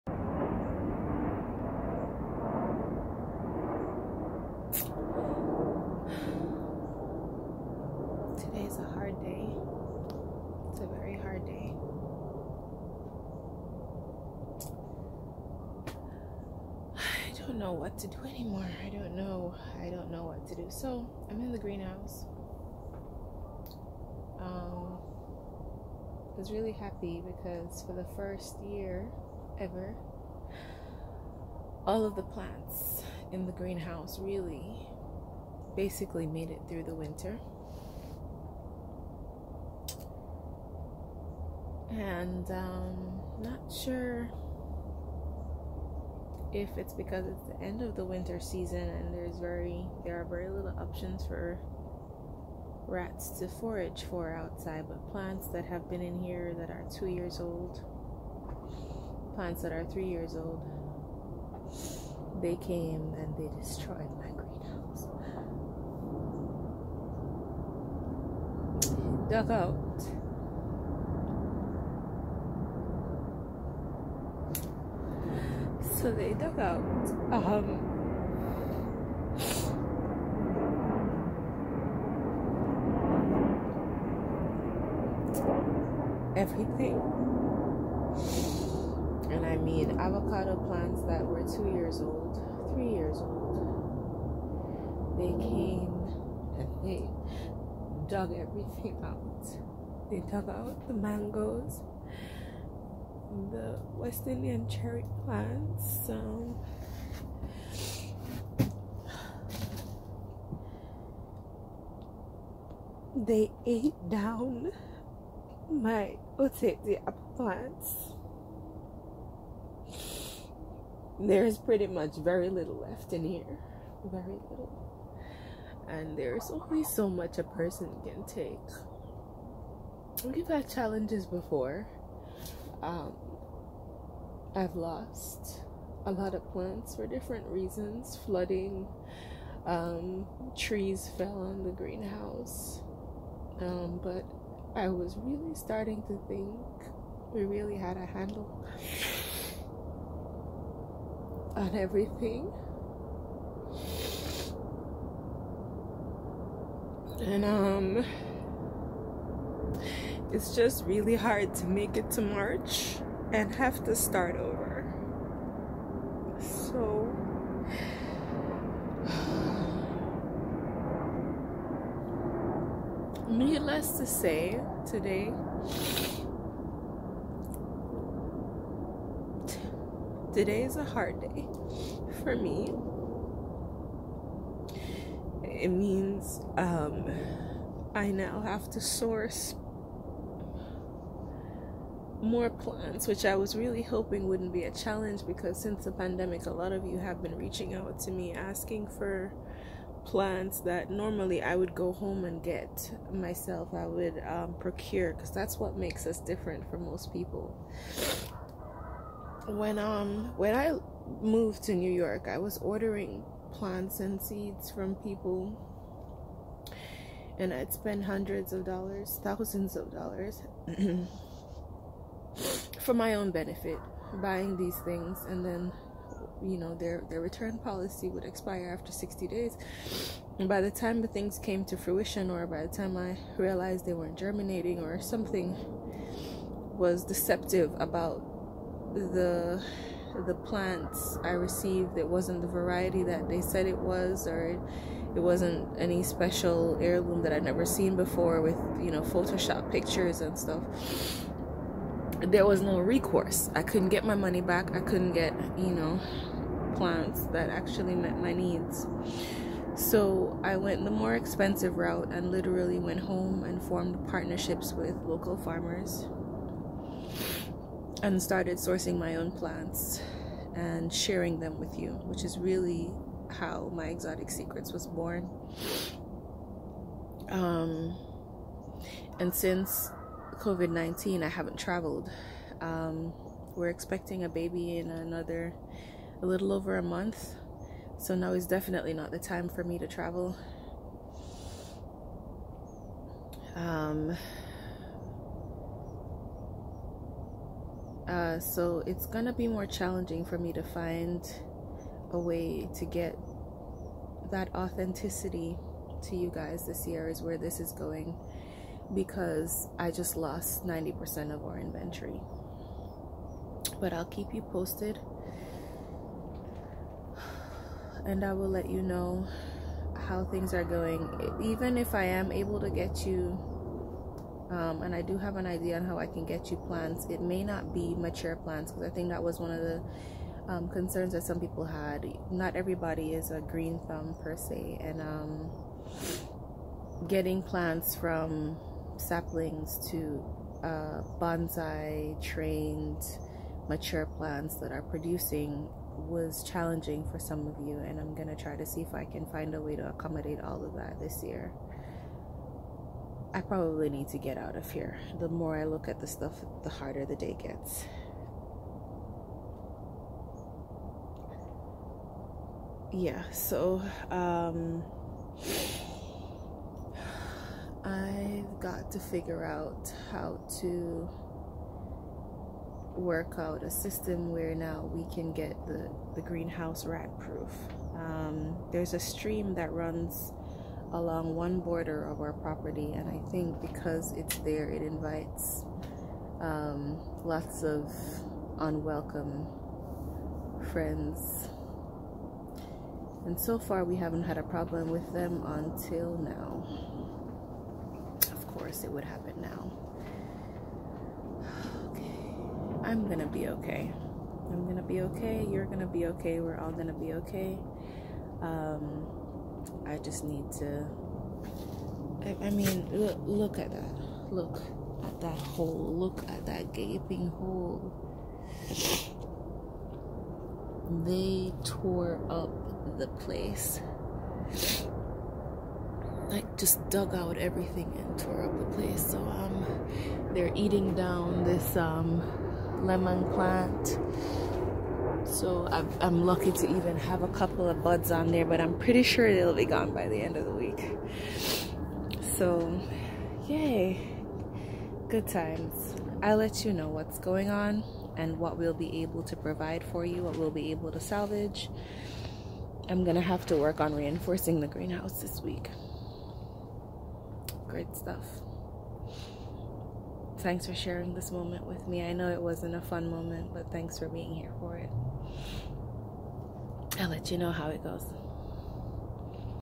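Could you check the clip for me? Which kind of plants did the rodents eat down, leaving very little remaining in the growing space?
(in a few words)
apple plants.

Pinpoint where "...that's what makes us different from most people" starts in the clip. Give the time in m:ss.
3:25.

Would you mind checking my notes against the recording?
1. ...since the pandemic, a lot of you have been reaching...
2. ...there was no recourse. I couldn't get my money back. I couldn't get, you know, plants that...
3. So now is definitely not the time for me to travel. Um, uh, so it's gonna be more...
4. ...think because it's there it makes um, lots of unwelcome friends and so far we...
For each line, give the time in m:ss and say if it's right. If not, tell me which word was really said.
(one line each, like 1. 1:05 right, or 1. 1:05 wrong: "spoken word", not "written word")
1. 3:15 right
2. 4:12 right
3. 4:47 right
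4. 6:23 wrong: "invites", not "makes".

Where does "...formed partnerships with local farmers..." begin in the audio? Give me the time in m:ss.
4:23.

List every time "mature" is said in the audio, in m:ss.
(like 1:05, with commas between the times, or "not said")
5:27, 5:43.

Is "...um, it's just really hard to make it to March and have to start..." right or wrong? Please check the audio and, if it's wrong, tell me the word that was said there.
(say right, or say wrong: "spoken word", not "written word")
right.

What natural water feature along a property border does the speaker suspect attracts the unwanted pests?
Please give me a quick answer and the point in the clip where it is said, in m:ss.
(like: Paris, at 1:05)
a stream, at 6:18.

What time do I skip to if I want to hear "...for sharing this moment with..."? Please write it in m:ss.
7:40.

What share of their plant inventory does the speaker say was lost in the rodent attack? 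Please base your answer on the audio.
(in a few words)
90%.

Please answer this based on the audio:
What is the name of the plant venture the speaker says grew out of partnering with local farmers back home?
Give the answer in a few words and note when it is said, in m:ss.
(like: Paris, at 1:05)
Exotic Secrets, at 4:33.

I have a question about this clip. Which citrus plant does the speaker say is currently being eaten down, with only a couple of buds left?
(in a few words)
lemon.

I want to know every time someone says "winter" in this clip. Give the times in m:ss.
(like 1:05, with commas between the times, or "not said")
0:36, 0:48.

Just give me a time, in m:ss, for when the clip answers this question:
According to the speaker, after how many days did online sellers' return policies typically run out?
3:48.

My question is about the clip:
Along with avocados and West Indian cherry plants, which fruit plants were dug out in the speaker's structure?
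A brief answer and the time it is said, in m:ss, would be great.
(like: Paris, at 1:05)
mangoes, at 1:40.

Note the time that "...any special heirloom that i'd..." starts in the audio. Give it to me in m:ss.
4:05.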